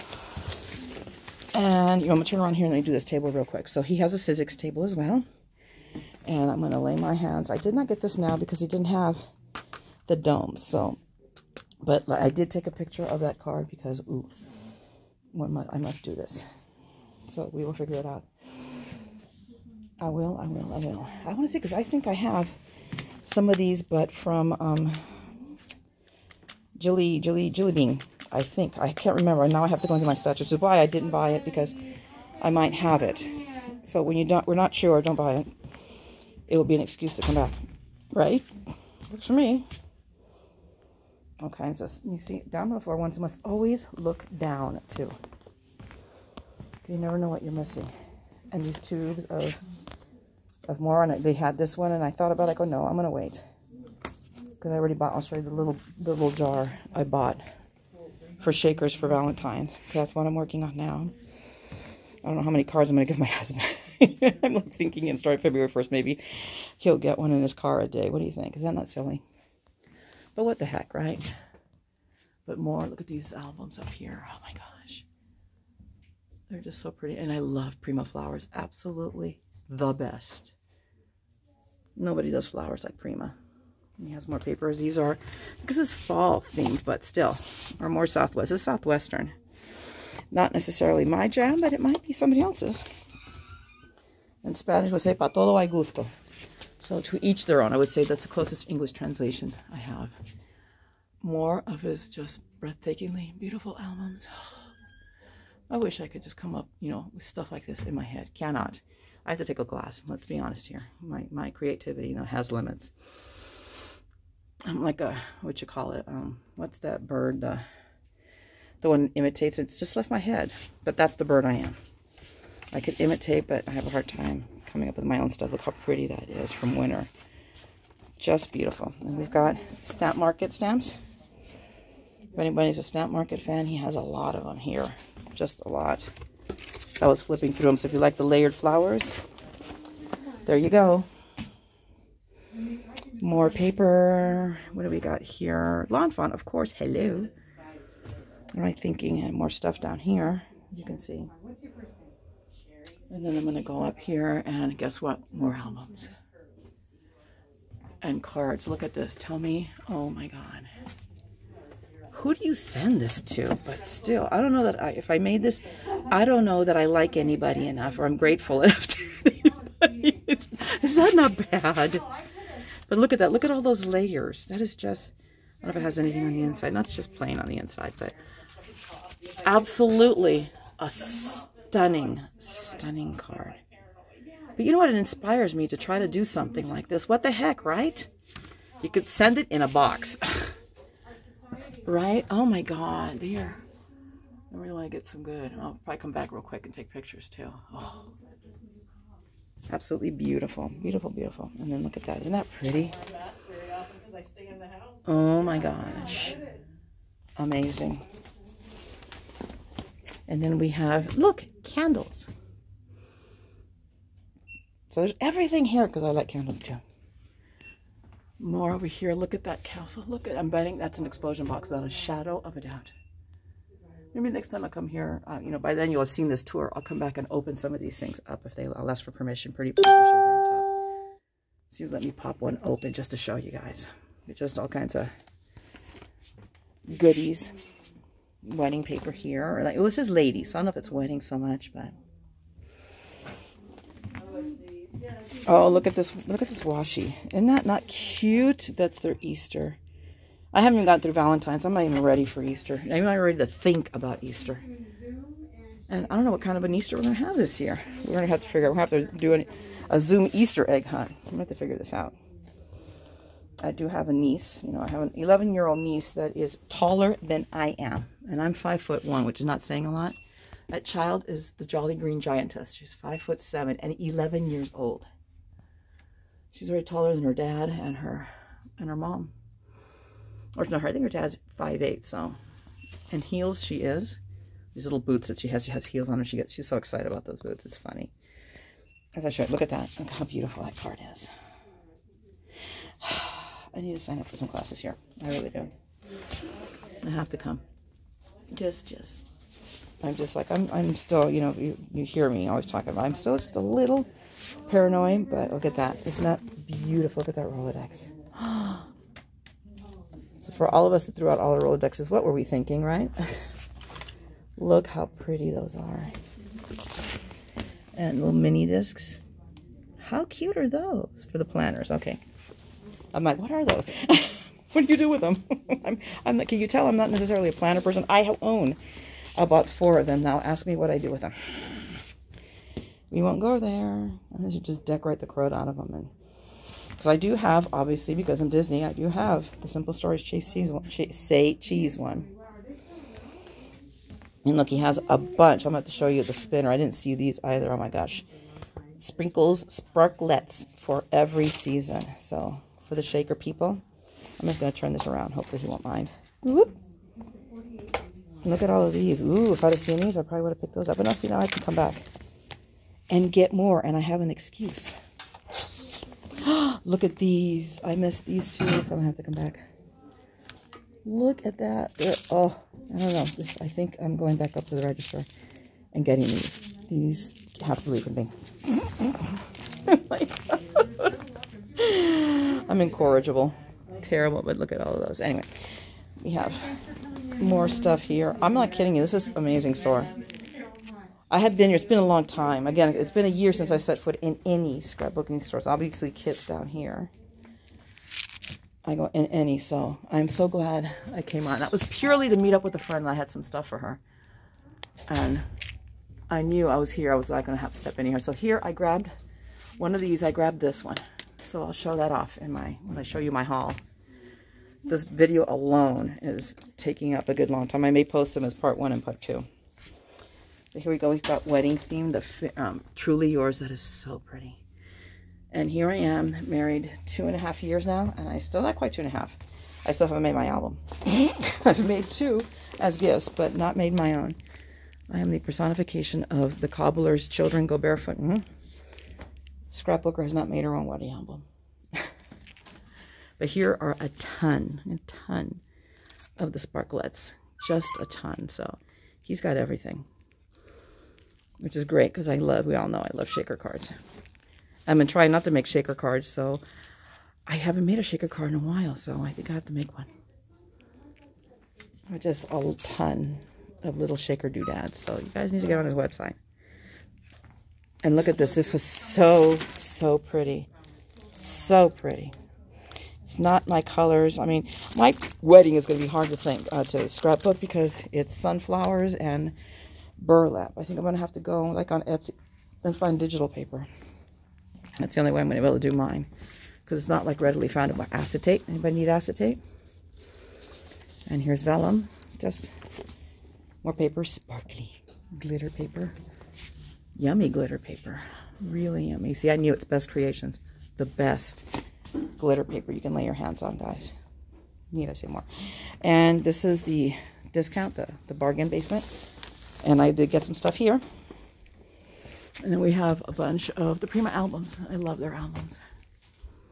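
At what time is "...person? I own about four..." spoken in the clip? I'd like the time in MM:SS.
05:27.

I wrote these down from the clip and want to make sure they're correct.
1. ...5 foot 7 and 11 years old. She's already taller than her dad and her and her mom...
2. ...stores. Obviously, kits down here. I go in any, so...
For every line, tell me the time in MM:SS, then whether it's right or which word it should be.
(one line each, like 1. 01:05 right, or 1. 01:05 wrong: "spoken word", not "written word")
1. 04:32 right
2. 06:35 right.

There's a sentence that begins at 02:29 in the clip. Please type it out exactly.
And uh, more stuff down here.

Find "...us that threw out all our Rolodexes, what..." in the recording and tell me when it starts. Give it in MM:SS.
05:10.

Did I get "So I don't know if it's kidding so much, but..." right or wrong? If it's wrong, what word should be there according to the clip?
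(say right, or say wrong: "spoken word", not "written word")
wrong: "wedding", not "kidding".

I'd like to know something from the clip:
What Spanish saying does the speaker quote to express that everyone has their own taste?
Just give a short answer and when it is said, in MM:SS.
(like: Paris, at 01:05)
para todo hay gusto, at 01:35.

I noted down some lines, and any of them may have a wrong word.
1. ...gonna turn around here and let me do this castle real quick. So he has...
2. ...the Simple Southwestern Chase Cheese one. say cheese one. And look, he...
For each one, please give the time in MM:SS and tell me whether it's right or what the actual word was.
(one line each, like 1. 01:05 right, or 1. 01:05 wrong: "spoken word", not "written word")
1. 00:02 wrong: "table", not "castle"
2. 05:39 wrong: "Stories", not "Southwestern".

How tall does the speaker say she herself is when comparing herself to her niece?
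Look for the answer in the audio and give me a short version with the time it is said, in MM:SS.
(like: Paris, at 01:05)
5 foot 1, at 04:28.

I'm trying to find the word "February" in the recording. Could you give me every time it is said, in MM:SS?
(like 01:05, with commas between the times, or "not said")
01:05.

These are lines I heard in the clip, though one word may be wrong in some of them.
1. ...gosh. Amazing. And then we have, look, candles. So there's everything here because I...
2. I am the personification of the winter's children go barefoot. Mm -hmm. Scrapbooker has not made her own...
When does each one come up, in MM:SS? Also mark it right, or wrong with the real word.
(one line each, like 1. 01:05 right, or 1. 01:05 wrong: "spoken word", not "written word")
1. 03:25 right
2. 07:15 wrong: "cobbler", not "winter".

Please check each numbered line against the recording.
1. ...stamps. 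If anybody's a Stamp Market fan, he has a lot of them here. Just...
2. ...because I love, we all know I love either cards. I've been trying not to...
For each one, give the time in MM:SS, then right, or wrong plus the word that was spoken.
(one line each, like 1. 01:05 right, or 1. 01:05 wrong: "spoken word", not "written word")
1. 02:10 right
2. 07:32 wrong: "shaker", not "either".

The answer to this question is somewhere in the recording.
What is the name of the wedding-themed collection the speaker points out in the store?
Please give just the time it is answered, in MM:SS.
07:02.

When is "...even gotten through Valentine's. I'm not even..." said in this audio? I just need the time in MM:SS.
04:10.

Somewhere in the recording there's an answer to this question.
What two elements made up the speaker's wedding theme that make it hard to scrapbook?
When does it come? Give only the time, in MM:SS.
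07:58.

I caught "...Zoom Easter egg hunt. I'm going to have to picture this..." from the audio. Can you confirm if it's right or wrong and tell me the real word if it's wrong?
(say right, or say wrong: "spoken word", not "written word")
wrong: "figure", not "picture".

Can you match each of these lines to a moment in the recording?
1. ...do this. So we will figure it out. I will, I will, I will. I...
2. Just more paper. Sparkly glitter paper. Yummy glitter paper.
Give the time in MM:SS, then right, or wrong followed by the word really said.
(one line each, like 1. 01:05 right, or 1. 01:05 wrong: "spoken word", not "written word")
1. 00:16 right
2. 08:12 right.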